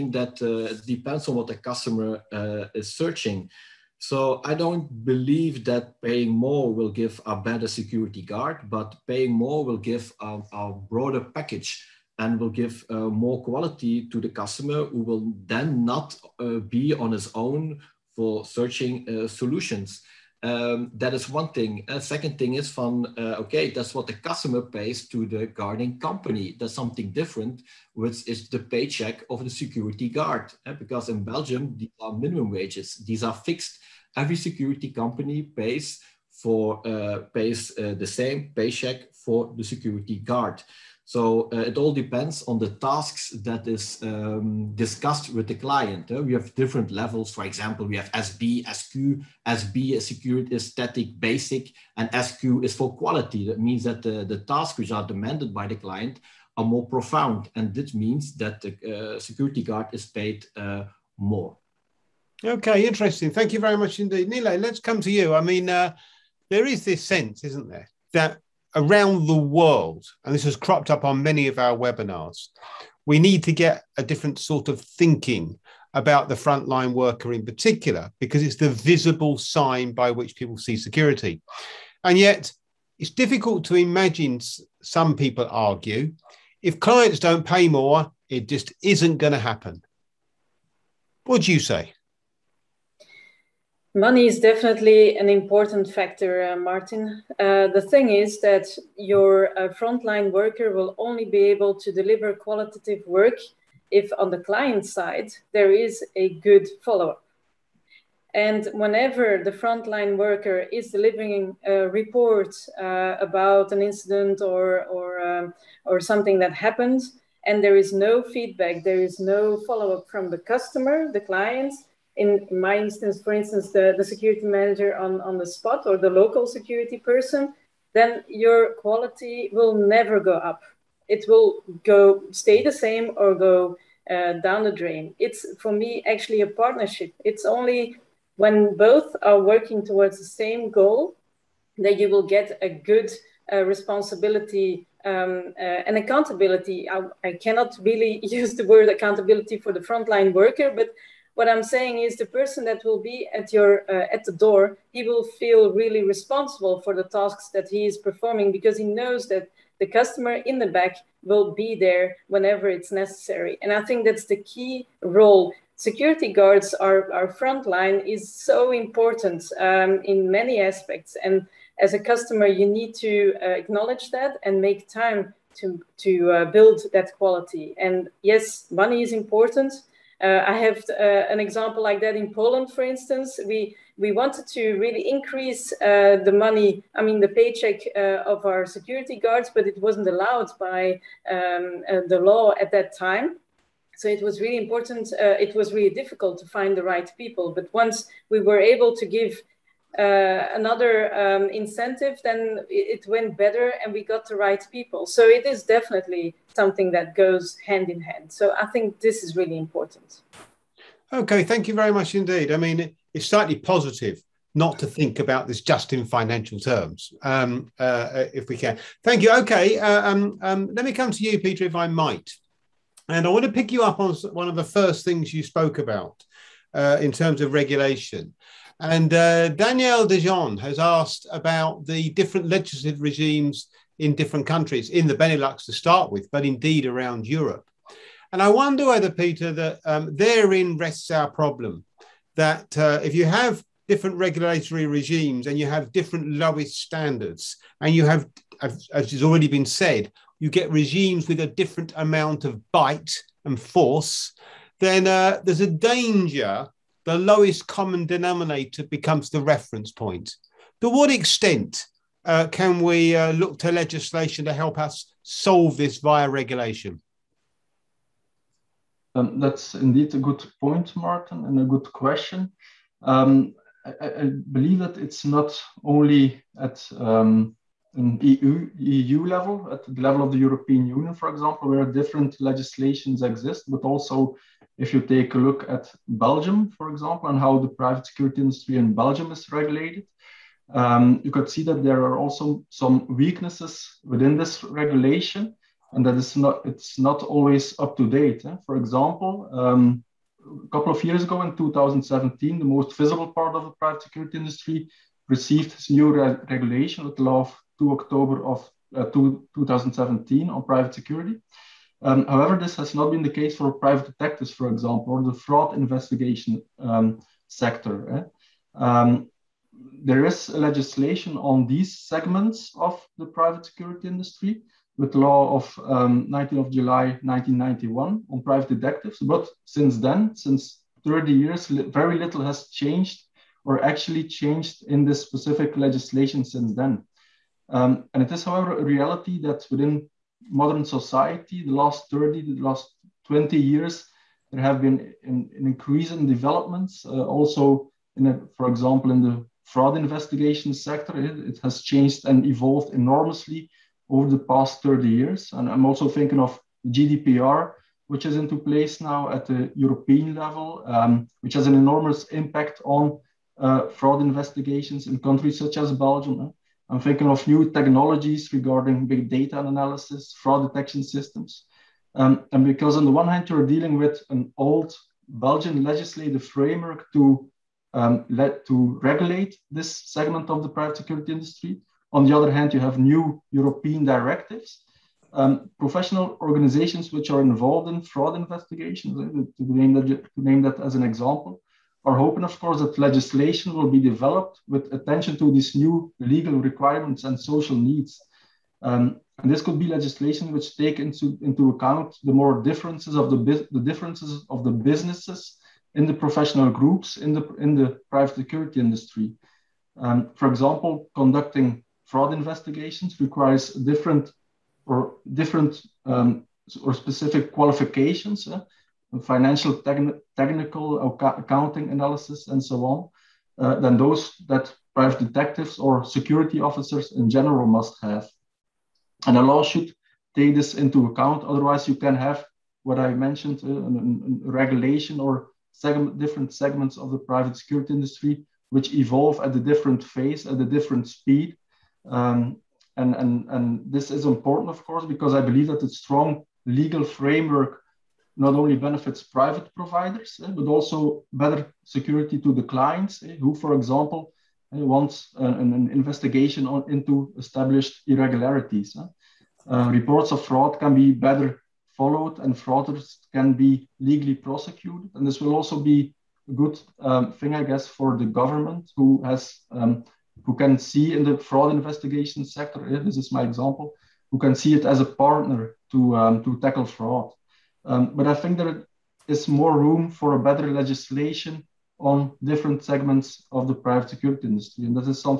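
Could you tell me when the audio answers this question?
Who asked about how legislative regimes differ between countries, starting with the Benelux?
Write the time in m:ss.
3:49.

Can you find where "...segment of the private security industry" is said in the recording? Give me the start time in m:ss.
6:20.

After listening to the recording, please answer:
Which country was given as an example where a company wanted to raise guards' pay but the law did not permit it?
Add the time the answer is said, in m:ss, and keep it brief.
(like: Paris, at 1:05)
Poland, at 3:02.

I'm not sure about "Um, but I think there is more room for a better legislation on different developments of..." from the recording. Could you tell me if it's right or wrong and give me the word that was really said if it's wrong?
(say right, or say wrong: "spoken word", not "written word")
wrong: "segments", not "developments".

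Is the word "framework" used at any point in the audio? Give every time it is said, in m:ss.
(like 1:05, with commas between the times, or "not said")
6:16, 7:27.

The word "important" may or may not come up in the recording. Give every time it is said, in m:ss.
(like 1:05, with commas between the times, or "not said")
1:35, 2:48, 2:59, 3:14, 3:29, 7:24.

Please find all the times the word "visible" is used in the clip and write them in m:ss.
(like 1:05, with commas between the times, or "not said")
1:18, 5:02.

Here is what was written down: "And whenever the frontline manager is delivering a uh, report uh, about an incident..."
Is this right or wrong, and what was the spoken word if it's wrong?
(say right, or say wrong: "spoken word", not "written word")
wrong: "worker", not "manager".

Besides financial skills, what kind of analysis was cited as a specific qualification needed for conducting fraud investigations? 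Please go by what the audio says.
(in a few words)
technical accounting analysis.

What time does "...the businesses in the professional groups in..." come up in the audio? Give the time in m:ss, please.
6:44.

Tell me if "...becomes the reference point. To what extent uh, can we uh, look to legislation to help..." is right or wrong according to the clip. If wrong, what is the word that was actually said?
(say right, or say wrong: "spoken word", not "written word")
right.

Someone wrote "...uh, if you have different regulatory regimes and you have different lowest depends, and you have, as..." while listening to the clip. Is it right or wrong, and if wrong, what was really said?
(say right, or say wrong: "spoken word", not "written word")
wrong: "standards", not "depends".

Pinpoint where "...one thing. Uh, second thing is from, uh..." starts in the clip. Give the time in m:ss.
0:21.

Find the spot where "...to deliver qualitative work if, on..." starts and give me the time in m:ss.
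1:41.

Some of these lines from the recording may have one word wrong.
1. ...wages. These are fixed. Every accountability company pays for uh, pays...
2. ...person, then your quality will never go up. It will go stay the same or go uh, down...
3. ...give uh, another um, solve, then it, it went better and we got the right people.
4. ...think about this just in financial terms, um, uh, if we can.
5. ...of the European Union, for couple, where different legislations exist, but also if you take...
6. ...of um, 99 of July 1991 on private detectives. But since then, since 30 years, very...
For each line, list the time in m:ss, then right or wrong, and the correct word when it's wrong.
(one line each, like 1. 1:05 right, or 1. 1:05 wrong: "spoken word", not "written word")
1. 0:32 wrong: "security", not "accountability"
2. 2:06 right
3. 3:19 wrong: "incentive", not "solve"
4. 3:34 right
5. 4:40 wrong: "example", not "couple"
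6. 5:25 wrong: "19", not "99".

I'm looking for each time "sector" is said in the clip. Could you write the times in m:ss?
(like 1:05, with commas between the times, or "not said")
5:17, 5:50, 7:52.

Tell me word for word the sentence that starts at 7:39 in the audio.
Uh, reports of fraud can be better followed and fraudsters can be legally prosecuted.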